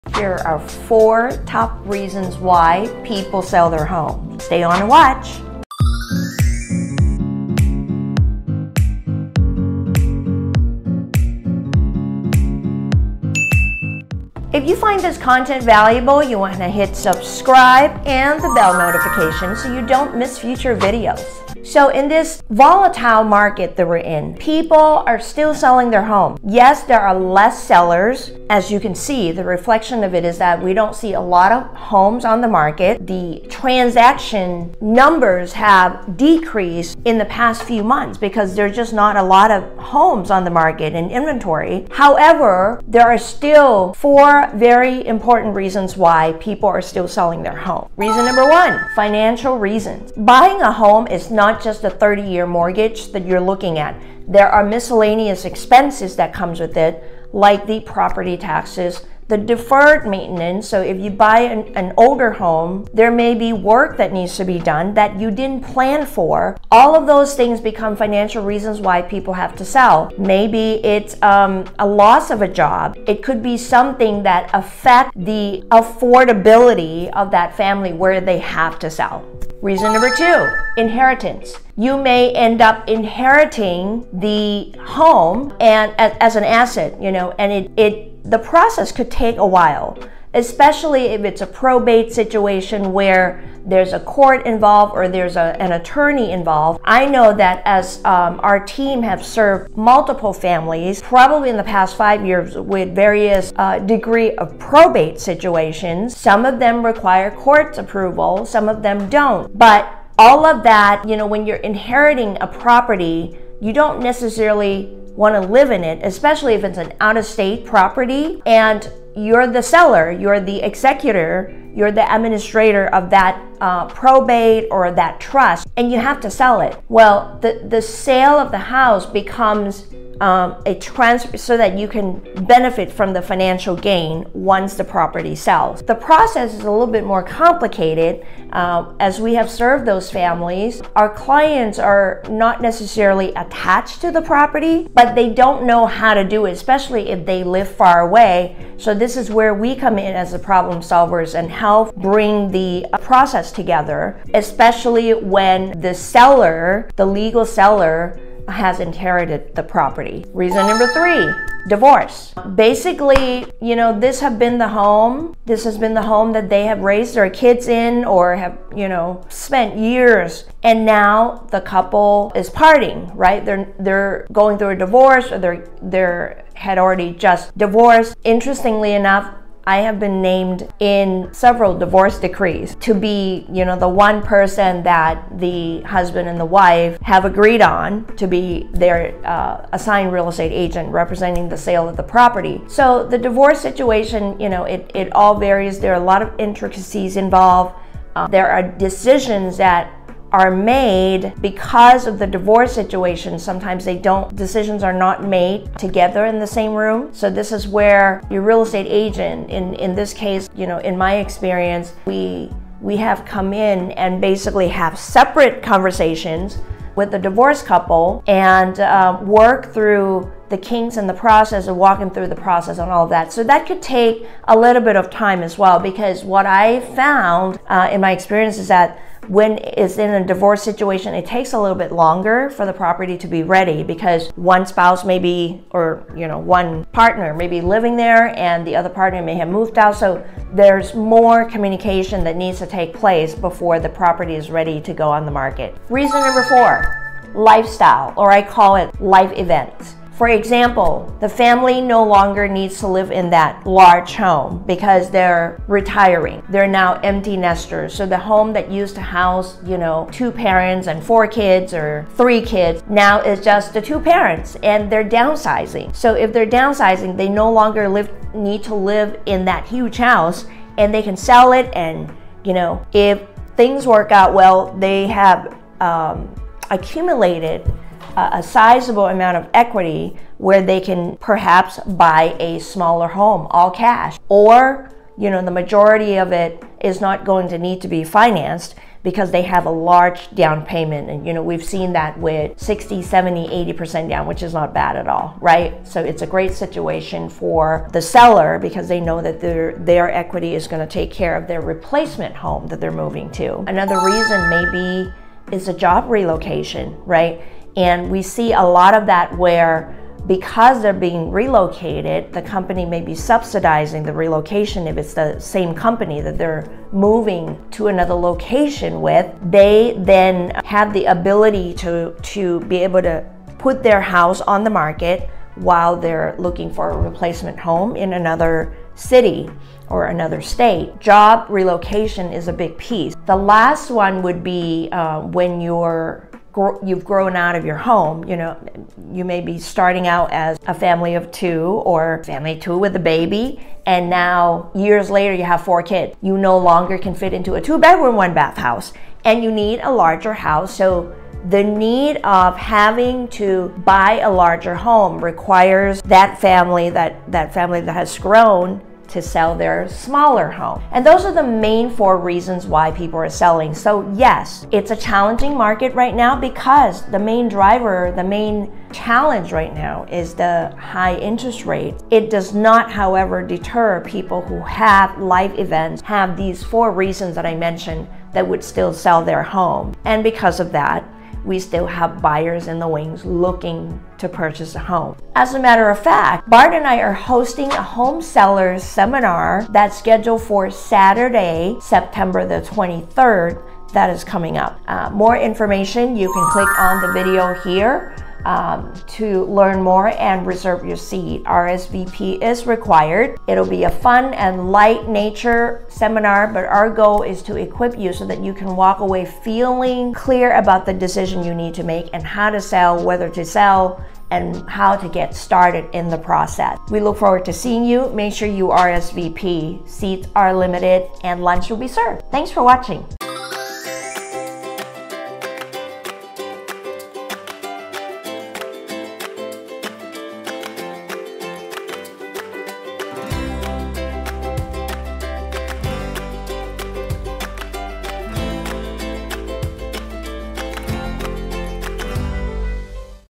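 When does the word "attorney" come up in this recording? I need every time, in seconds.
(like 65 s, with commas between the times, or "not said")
95 s.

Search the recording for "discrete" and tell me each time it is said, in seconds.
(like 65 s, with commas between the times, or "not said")
not said.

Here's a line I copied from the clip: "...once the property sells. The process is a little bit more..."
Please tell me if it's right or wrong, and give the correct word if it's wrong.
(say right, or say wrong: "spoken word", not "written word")
right.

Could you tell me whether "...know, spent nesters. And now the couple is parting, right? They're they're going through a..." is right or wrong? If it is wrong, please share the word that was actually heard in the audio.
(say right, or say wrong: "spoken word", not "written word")
wrong: "years", not "nesters".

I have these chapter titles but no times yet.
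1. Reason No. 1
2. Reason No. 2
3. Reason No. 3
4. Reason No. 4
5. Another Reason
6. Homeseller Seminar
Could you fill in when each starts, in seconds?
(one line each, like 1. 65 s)
1. 47 s
2. 80 s
3. 160 s
4. 245 s
5. 304 s
6. 386 s.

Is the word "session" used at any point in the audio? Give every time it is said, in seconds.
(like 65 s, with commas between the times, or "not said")
not said.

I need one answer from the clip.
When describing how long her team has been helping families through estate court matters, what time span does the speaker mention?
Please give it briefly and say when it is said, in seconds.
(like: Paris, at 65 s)
5 years, at 101 s.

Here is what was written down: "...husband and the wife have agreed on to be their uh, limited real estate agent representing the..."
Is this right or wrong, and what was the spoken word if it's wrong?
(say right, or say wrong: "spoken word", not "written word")
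wrong: "assigned", not "limited".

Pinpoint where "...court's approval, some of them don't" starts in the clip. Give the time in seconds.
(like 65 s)
107 s.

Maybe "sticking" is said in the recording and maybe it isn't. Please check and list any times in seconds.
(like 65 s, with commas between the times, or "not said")
not said.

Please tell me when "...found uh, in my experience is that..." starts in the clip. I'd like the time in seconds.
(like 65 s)
226 s.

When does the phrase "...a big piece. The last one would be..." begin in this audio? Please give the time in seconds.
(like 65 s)
332 s.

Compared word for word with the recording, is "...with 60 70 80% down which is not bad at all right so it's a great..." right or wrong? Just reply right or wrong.
right.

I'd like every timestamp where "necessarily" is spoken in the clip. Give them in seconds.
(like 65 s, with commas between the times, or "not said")
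114 s, 142 s.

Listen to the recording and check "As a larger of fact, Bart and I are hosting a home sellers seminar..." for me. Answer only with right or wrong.
wrong.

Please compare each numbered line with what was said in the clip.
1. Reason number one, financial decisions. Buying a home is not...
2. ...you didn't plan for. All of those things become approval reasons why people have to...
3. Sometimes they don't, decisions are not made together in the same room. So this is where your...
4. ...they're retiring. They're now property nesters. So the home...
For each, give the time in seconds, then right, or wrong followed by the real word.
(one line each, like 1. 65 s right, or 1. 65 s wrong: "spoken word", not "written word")
1. 47 s wrong: "reasons", not "decisions"
2. 65 s wrong: "financial", not "approval"
3. 203 s right
4. 255 s wrong: "empty", not "property".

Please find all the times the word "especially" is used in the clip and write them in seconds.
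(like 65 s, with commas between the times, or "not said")
90 s, 116 s, 146 s, 154 s.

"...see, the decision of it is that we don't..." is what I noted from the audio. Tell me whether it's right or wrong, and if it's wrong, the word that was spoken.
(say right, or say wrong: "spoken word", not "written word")
wrong: "reflection", not "decision".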